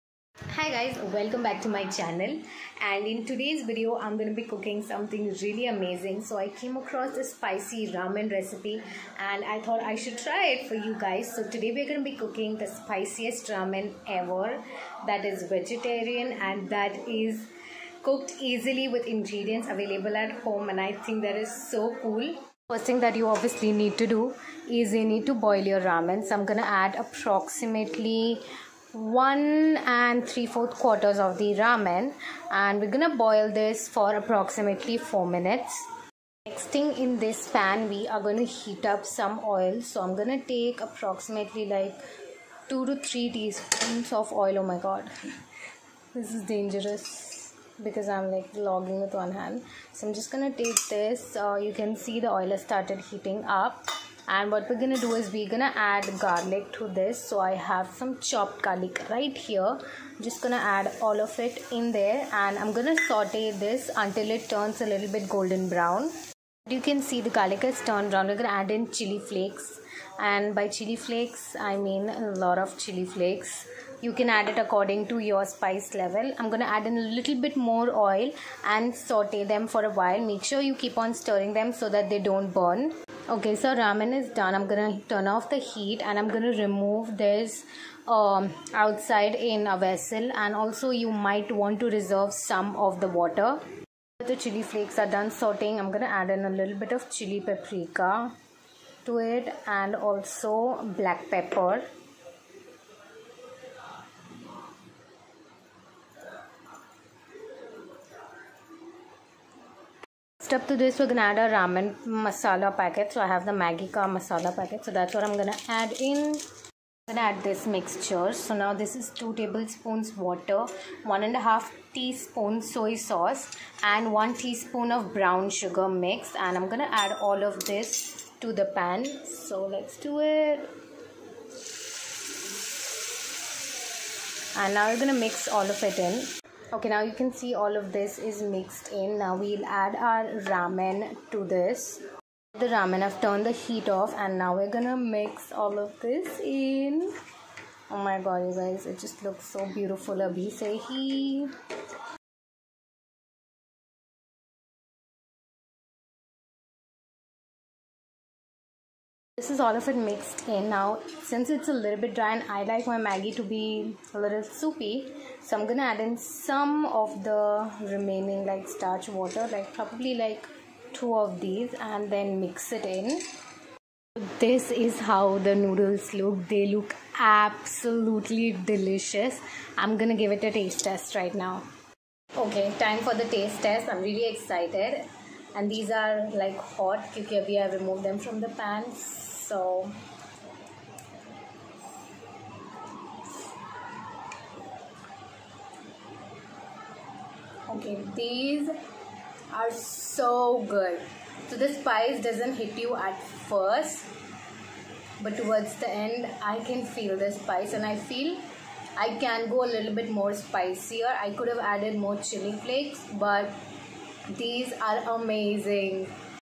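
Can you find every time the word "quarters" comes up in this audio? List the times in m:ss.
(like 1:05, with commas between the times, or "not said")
0:30.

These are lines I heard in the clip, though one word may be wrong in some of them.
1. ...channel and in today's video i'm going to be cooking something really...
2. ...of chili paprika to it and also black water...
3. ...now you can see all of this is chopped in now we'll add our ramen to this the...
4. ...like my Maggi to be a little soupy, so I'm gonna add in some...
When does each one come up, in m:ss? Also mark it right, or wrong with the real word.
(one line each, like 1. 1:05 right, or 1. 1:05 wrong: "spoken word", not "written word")
1. 0:01 right
2. 1:36 wrong: "pepper", not "water"
3. 2:16 wrong: "mixed", not "chopped"
4. 2:42 right.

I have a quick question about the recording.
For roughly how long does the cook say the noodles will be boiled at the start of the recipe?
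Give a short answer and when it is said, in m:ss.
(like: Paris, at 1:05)
4 minutes, at 0:34.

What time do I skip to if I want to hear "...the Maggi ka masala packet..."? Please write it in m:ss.
1:53.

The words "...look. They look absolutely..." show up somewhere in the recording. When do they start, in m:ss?
2:56.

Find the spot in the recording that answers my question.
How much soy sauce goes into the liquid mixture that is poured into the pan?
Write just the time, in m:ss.
2:01.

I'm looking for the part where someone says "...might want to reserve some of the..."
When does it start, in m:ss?
1:31.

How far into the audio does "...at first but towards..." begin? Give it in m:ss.
3:22.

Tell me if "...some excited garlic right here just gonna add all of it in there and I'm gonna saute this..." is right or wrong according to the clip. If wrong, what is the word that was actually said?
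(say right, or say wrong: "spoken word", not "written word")
wrong: "chopped", not "excited".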